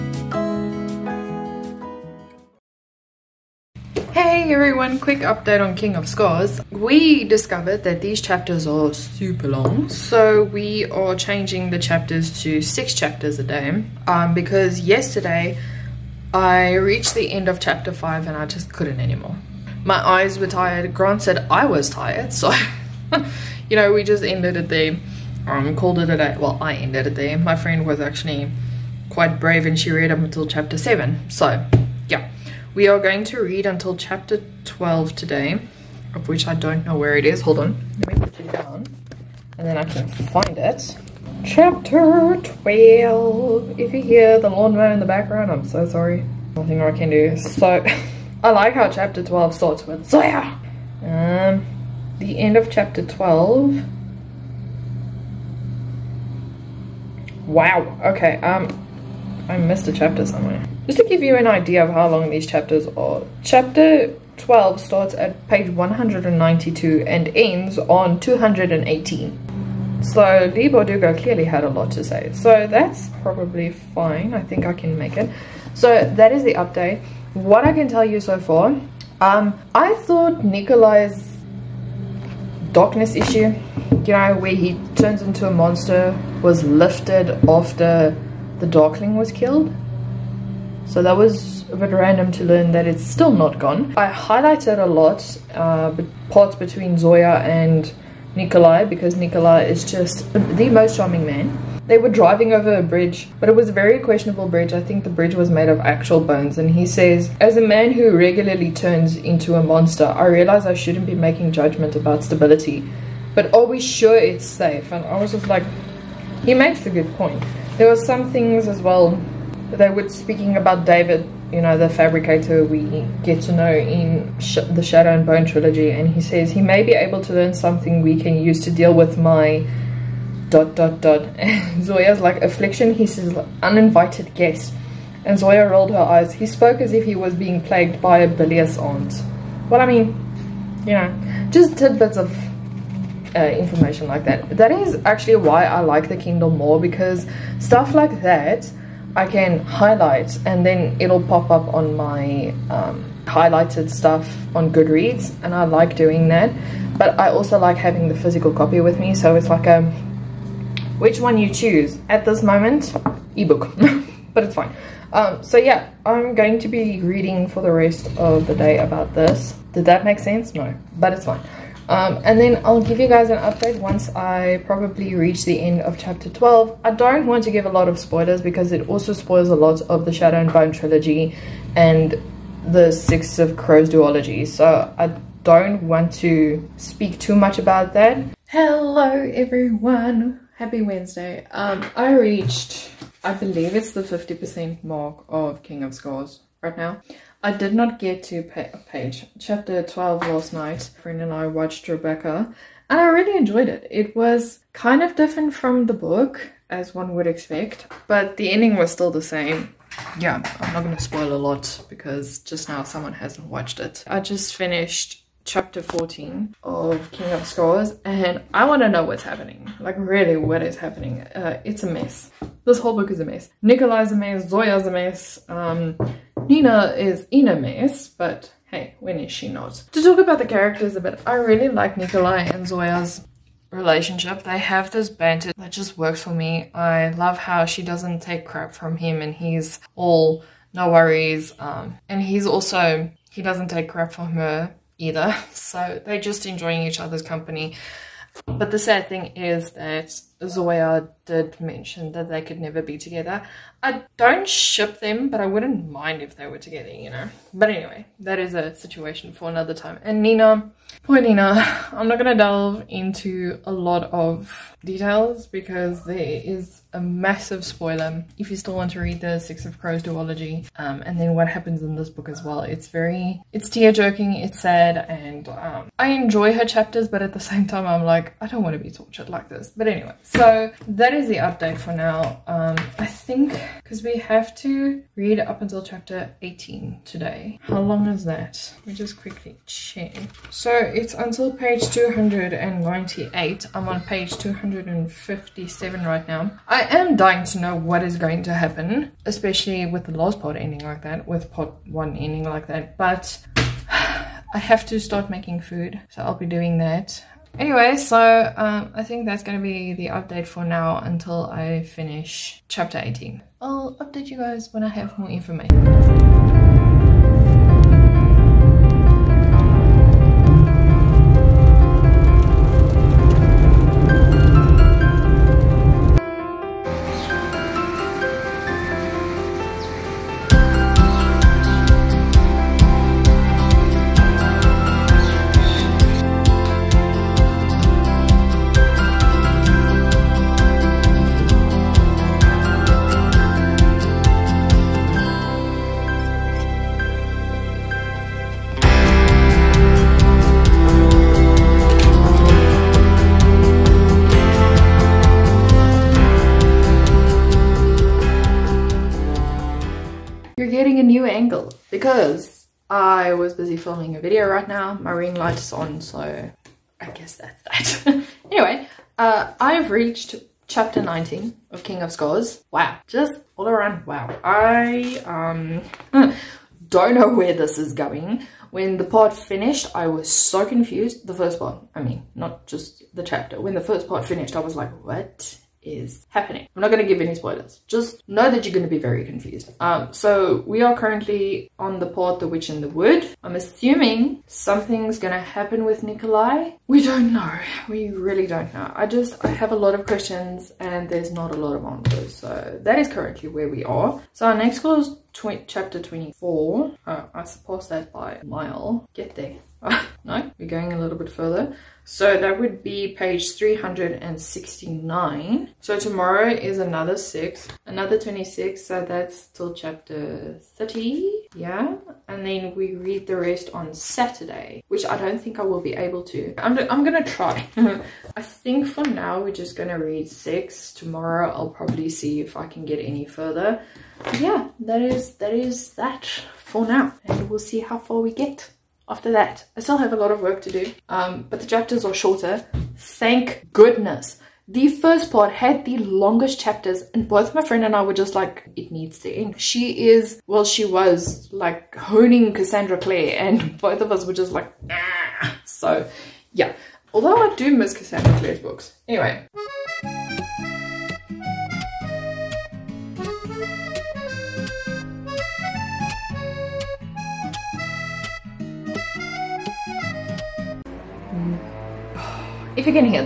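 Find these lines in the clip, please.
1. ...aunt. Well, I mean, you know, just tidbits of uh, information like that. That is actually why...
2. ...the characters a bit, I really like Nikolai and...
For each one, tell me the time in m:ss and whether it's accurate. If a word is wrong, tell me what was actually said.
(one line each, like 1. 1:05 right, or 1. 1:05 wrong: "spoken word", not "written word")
1. 2:18 right
2. 3:50 right.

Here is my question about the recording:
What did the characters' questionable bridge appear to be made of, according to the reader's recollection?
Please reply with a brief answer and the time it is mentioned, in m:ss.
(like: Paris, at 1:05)
Bones, at 1:45.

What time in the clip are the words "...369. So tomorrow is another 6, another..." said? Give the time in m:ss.
6:53.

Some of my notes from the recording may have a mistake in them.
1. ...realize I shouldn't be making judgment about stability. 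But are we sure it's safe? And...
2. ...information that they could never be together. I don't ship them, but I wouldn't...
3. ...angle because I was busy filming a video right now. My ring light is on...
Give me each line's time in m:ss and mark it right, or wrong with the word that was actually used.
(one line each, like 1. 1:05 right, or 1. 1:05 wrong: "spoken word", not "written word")
1. 1:50 right
2. 4:11 wrong: "mention", not "information"
3. 6:01 right.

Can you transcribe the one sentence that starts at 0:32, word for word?
We are going to read until chapter 12 today, of which I don't know where it is.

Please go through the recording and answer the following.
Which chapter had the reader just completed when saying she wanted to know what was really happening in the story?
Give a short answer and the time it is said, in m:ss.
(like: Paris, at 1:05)
Chapter 14, at 3:35.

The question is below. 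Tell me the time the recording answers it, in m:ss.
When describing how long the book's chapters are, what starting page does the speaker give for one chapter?
1:05.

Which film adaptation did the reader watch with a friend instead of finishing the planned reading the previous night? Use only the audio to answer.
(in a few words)
Rebecca.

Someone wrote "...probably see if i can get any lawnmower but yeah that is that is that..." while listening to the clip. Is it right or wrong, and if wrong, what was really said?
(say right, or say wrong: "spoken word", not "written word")
wrong: "further", not "lawnmower".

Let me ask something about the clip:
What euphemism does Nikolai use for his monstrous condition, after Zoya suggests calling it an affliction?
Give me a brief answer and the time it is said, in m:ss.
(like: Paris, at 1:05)
Uninvited guest, at 2:13.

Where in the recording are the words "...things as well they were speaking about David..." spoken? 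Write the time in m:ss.
1:58.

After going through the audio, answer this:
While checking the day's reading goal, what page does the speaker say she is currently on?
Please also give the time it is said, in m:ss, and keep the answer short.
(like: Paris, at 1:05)
257, at 4:54.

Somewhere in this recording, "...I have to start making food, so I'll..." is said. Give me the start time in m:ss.
5:03.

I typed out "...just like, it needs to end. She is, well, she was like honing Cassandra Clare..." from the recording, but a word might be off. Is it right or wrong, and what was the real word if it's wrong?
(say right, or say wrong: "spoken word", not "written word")
right.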